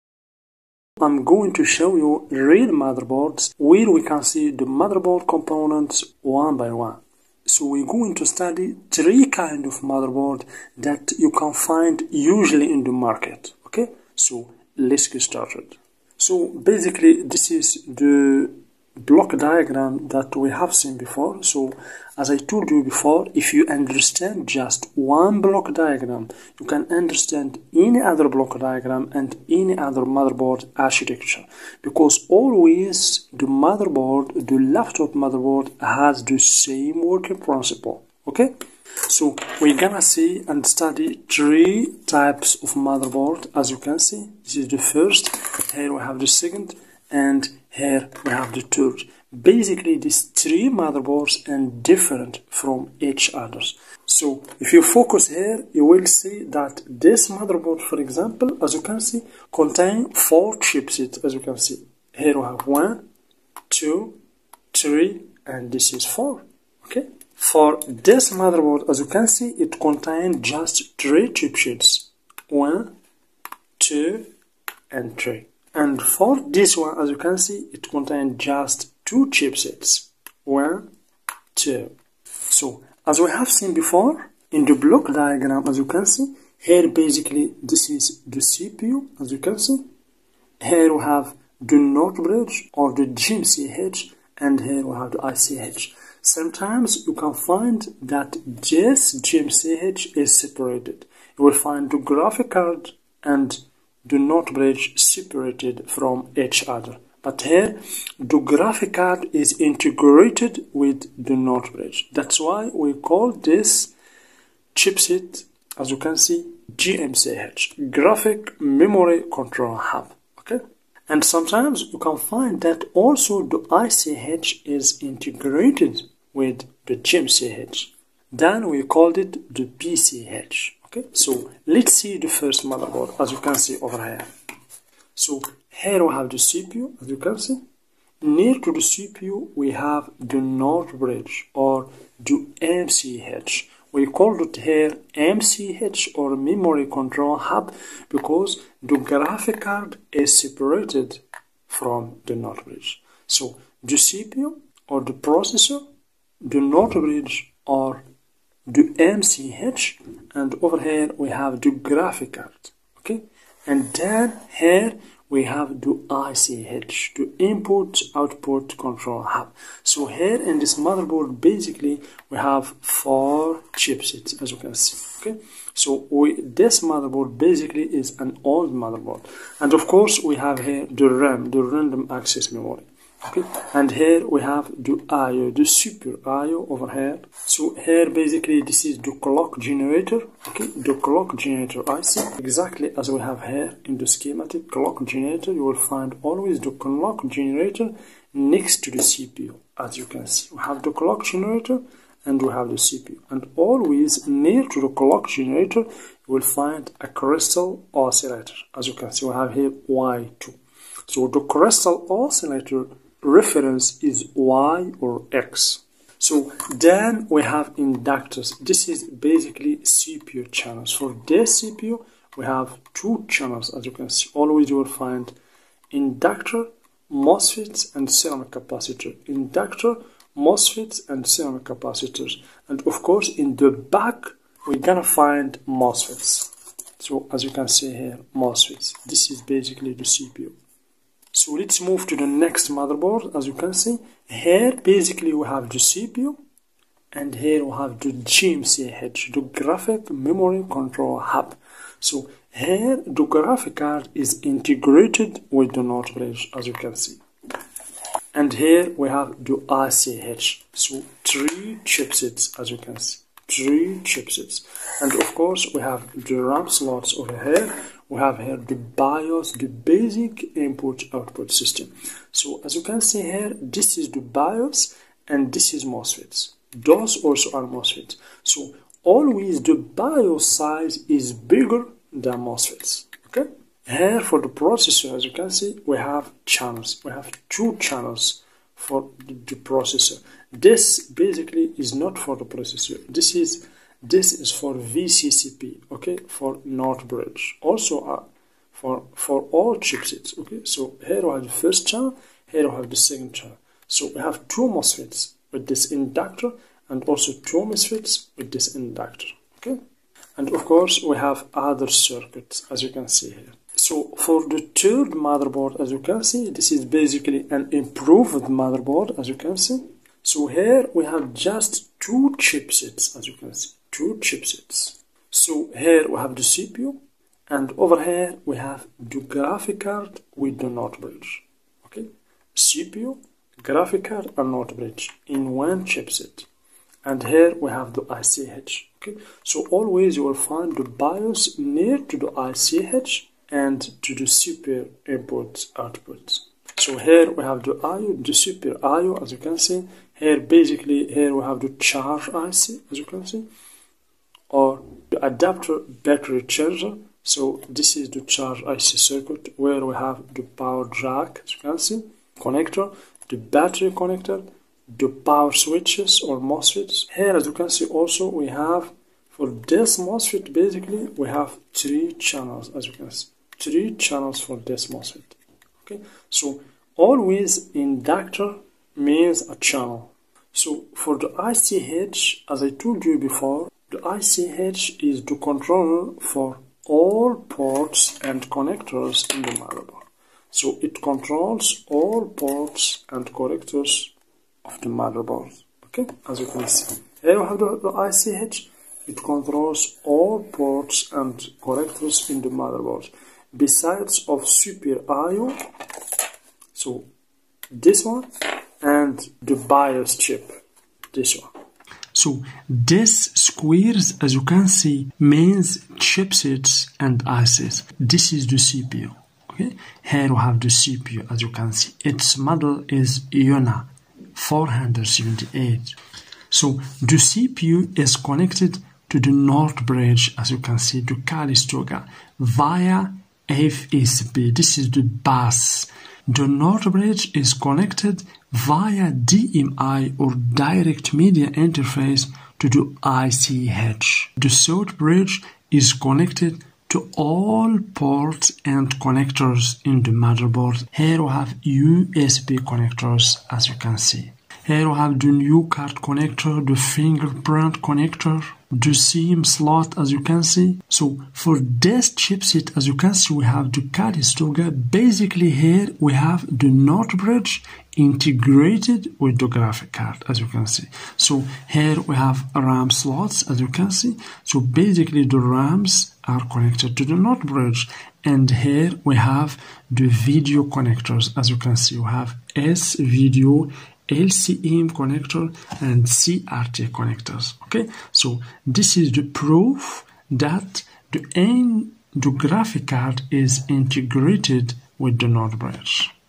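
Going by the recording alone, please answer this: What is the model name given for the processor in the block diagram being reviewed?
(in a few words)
Iona 478.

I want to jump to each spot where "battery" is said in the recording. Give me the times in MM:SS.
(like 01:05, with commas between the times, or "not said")
05:56, 06:03.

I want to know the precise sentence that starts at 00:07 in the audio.
So we're going to study three kind of motherboard that you can find usually in the market.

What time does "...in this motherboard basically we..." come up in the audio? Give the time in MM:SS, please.
02:50.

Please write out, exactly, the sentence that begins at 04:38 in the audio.
So always the BIOS size is bigger than MOSFETs.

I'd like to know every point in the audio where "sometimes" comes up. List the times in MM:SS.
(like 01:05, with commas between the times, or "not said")
01:36, 02:01.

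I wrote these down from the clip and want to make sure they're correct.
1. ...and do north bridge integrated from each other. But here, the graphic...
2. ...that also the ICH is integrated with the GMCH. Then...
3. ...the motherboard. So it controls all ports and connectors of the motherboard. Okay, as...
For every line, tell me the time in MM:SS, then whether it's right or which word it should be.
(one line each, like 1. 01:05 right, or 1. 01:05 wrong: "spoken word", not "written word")
1. 01:43 wrong: "separated", not "integrated"
2. 02:02 right
3. 06:29 right.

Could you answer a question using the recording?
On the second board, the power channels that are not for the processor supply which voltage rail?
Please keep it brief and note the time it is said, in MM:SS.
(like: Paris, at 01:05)
VCCP, at 04:54.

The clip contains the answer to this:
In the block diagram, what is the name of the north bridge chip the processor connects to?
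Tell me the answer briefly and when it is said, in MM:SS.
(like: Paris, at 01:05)
Calistoga, at 07:11.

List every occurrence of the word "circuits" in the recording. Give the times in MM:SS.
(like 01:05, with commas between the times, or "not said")
05:11, 05:59.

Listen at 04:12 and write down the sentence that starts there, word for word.
So here the graphic card is integrated with the notebook, as you can see.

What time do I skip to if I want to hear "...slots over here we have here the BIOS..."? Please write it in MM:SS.
04:26.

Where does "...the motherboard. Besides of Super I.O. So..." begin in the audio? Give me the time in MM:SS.
06:42.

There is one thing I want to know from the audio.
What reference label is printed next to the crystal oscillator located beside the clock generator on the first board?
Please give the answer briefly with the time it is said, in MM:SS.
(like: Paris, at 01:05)
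Y2, at 03:29.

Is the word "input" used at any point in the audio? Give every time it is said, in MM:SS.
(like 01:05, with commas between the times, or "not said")
02:47, 04:30, 05:45.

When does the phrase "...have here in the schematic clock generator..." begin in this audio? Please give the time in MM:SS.
03:13.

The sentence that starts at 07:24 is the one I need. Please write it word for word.
The South Bridge is connected to all ports and connectors in the motherboard.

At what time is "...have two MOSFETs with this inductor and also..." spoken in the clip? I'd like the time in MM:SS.
05:04.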